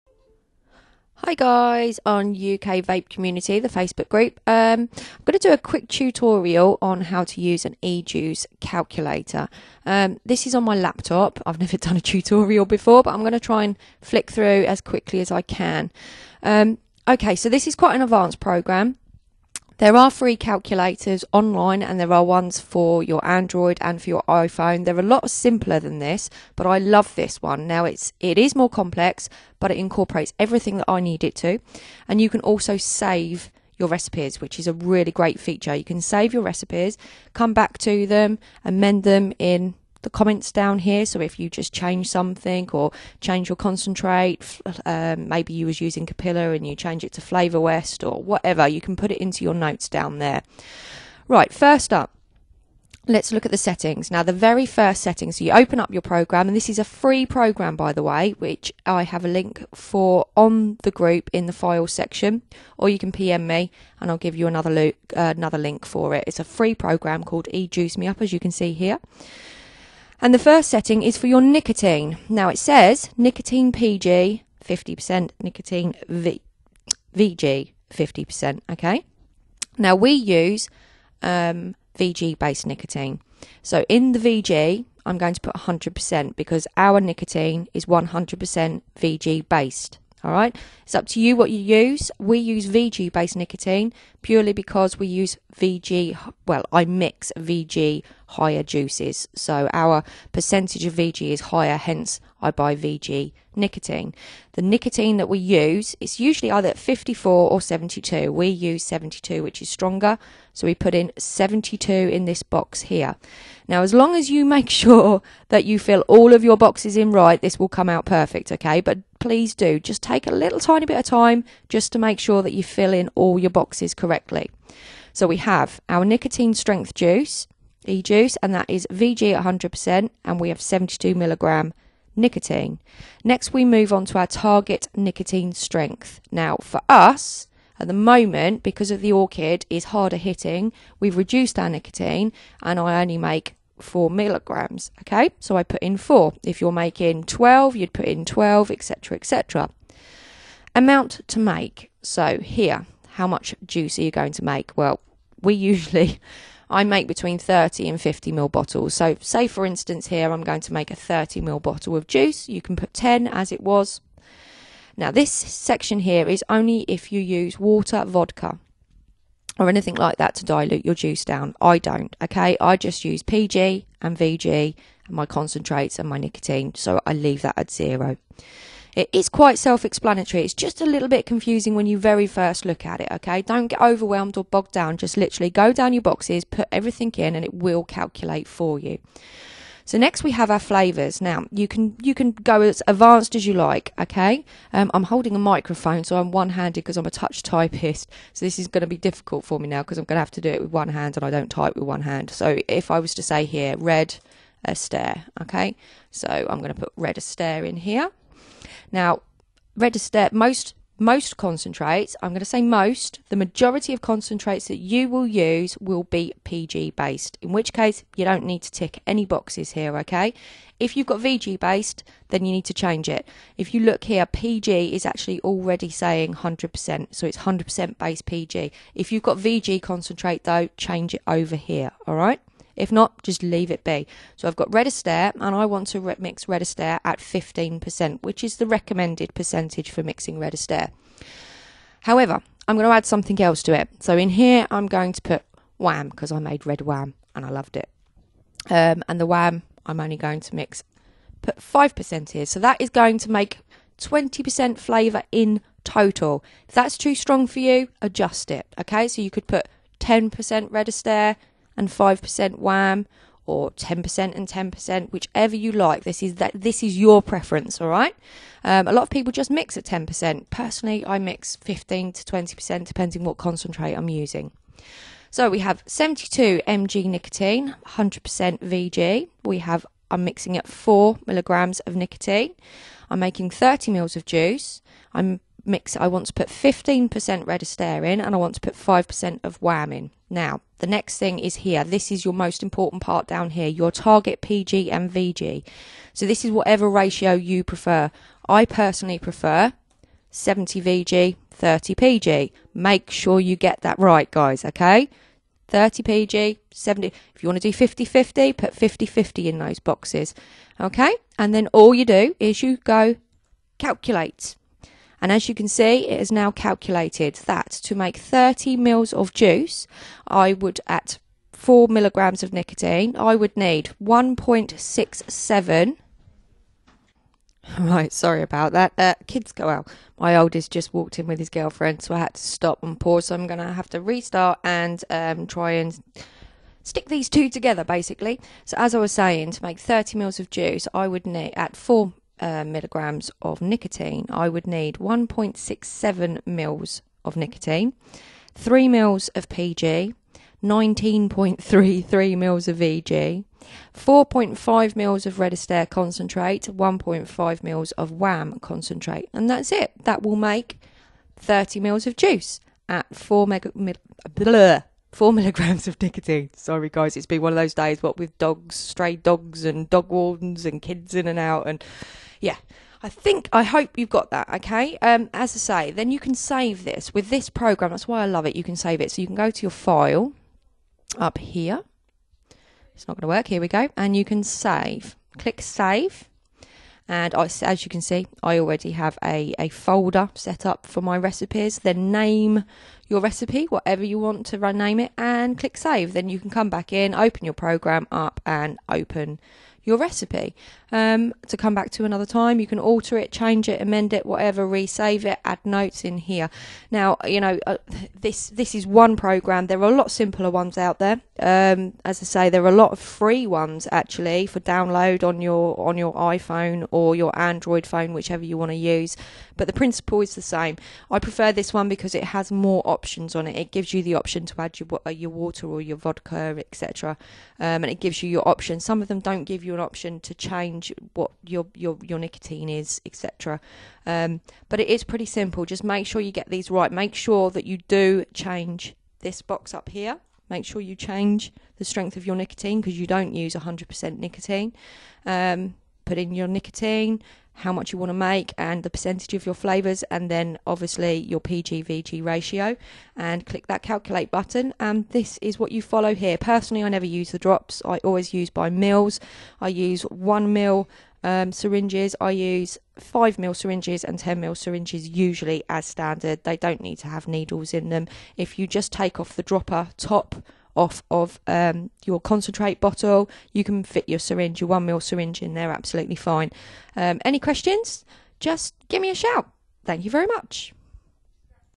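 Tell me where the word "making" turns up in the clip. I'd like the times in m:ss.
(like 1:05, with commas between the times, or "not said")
2:26, 4:43.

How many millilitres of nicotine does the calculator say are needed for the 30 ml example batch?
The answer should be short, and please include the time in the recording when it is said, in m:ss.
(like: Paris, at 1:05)
1.67 ml, at 5:44.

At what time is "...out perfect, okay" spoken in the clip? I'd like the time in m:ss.
1:57.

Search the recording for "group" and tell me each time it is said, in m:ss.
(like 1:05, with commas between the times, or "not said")
0:04, 1:00.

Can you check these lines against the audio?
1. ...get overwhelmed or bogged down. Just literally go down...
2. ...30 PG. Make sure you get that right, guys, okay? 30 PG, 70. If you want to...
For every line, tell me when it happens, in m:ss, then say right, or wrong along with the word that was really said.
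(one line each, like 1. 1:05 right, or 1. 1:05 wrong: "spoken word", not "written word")
1. 3:03 right
2. 5:01 right.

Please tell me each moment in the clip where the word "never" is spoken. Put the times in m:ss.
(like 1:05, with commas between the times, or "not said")
0:11, 7:36.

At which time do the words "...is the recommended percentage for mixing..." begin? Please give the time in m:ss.
3:58.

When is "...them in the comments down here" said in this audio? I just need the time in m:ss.
0:39.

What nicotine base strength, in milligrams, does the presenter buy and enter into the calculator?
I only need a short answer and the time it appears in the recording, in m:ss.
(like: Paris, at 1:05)
72, at 1:48.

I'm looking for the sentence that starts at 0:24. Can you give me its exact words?
They're a lot simpler than this, but I love this one.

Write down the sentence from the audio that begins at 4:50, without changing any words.
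Now, the next thing is here.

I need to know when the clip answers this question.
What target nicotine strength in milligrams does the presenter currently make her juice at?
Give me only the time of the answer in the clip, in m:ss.
2:22.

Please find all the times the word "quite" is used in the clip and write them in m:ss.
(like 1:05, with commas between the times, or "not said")
0:17, 2:59.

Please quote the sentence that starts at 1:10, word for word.
And the first setting is for your nicotine.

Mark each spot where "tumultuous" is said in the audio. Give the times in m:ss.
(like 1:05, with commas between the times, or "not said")
not said.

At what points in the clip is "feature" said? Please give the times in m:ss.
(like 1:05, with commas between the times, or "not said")
0:35.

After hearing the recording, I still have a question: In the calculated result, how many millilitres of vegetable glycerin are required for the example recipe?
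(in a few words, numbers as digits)
19.33 ml.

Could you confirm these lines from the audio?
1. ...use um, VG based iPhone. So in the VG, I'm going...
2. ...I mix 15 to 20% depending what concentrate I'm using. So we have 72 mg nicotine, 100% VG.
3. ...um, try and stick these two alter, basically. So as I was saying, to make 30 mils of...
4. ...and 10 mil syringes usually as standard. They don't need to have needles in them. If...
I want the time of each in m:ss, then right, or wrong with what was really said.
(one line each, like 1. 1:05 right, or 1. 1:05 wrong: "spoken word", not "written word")
1. 1:20 wrong: "nicotine", not "iPhone"
2. 4:31 right
3. 5:35 wrong: "together", not "alter"
4. 7:44 right.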